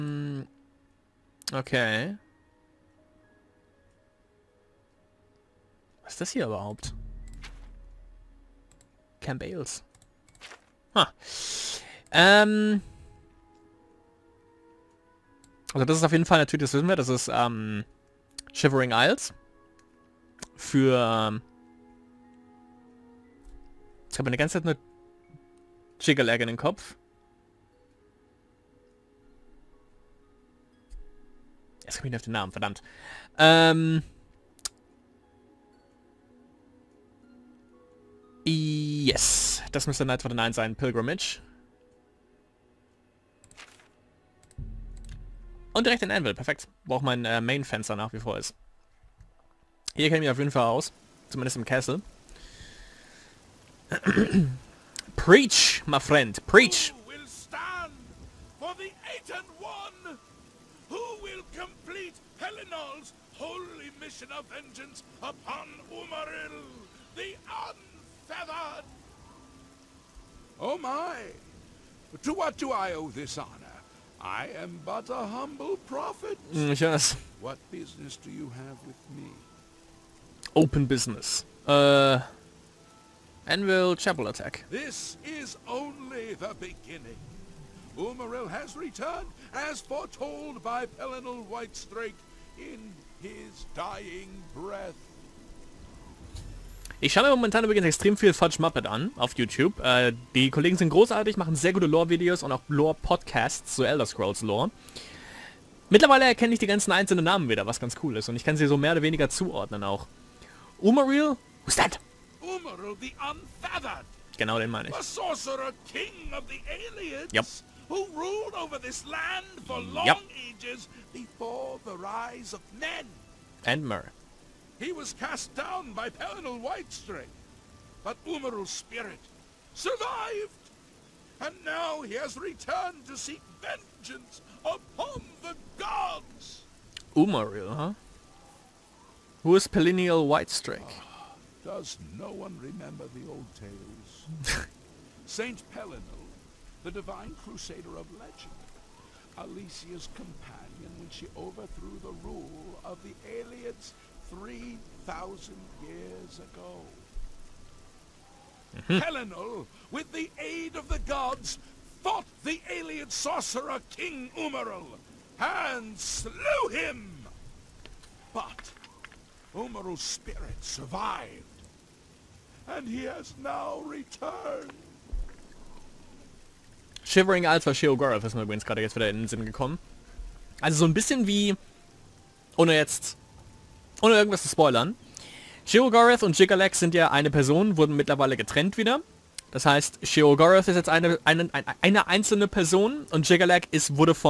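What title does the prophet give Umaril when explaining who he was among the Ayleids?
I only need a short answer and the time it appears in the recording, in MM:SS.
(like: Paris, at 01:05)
The sorcerer king, at 01:54.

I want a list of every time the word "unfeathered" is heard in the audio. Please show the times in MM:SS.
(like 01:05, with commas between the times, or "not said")
01:07, 01:53.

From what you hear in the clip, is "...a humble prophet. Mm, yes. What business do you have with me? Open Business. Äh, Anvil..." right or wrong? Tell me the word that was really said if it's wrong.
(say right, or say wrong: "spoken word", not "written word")
right.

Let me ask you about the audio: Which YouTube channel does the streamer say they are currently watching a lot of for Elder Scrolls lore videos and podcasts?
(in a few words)
Fudge Muppet.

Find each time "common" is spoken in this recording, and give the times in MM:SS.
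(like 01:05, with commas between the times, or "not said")
not said.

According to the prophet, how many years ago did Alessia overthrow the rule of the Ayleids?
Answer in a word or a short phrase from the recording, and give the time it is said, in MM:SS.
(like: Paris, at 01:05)
3,000, at 02:34.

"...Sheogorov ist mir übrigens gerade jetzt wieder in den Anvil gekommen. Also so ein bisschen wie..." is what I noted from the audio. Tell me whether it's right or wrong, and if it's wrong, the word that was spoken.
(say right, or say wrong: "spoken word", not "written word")
wrong: "Sinn", not "Anvil".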